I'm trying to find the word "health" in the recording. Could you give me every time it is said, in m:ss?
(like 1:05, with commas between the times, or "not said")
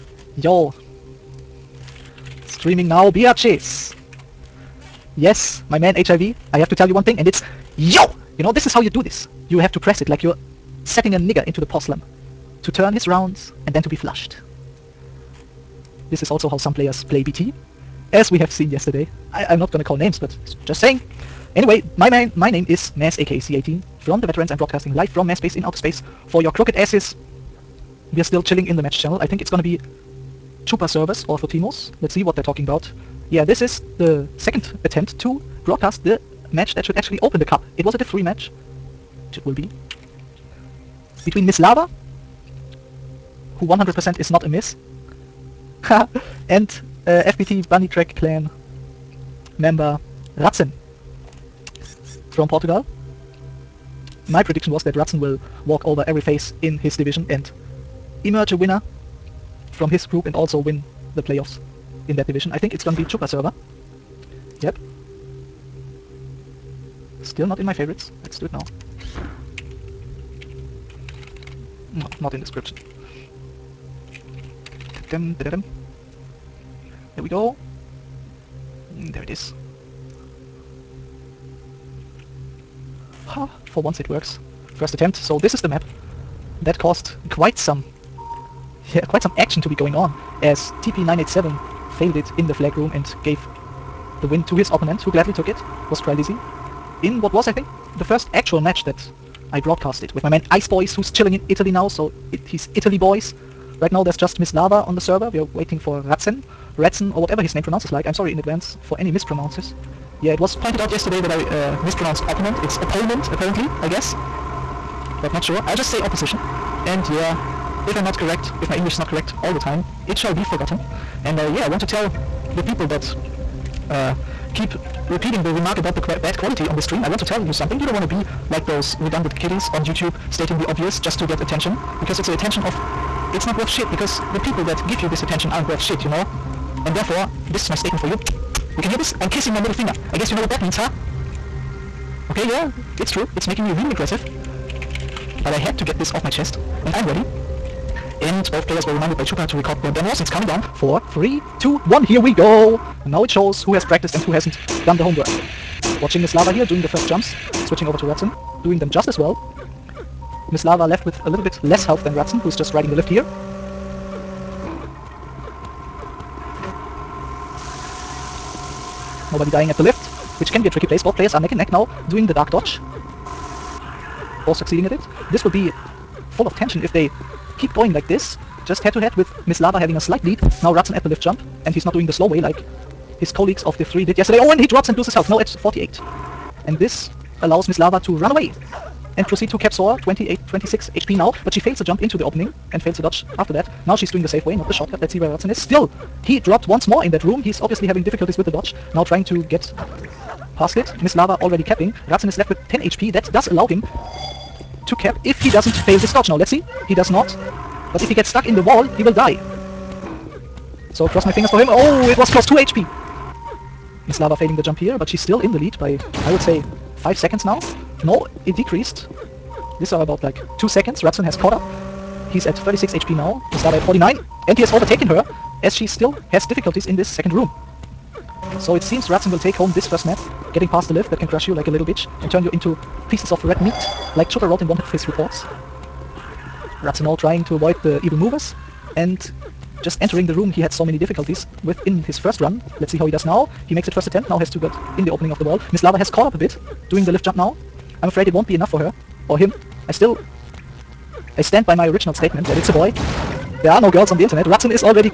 2:41, 3:05.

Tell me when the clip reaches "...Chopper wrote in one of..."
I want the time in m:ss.
3:54.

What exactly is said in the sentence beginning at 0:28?
We are still chilling in the match channel.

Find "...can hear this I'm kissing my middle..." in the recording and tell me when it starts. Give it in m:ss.
2:18.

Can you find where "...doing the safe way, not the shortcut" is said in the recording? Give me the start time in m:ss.
3:14.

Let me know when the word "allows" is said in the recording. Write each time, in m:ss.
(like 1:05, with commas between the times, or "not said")
3:07, 3:23.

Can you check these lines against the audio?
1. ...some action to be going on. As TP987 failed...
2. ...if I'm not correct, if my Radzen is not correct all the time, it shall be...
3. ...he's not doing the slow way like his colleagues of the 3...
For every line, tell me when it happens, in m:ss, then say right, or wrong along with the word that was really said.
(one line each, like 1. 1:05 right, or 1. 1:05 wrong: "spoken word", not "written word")
1. 1:29 right
2. 1:57 wrong: "English", not "Radzen"
3. 3:01 right.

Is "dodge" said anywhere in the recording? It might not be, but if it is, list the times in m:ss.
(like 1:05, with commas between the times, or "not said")
2:52, 3:13, 3:18, 3:26.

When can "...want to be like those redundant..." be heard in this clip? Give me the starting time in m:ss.
2:07.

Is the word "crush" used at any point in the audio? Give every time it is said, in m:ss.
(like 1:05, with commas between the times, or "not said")
3:51.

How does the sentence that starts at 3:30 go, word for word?
So cross my fingers for him.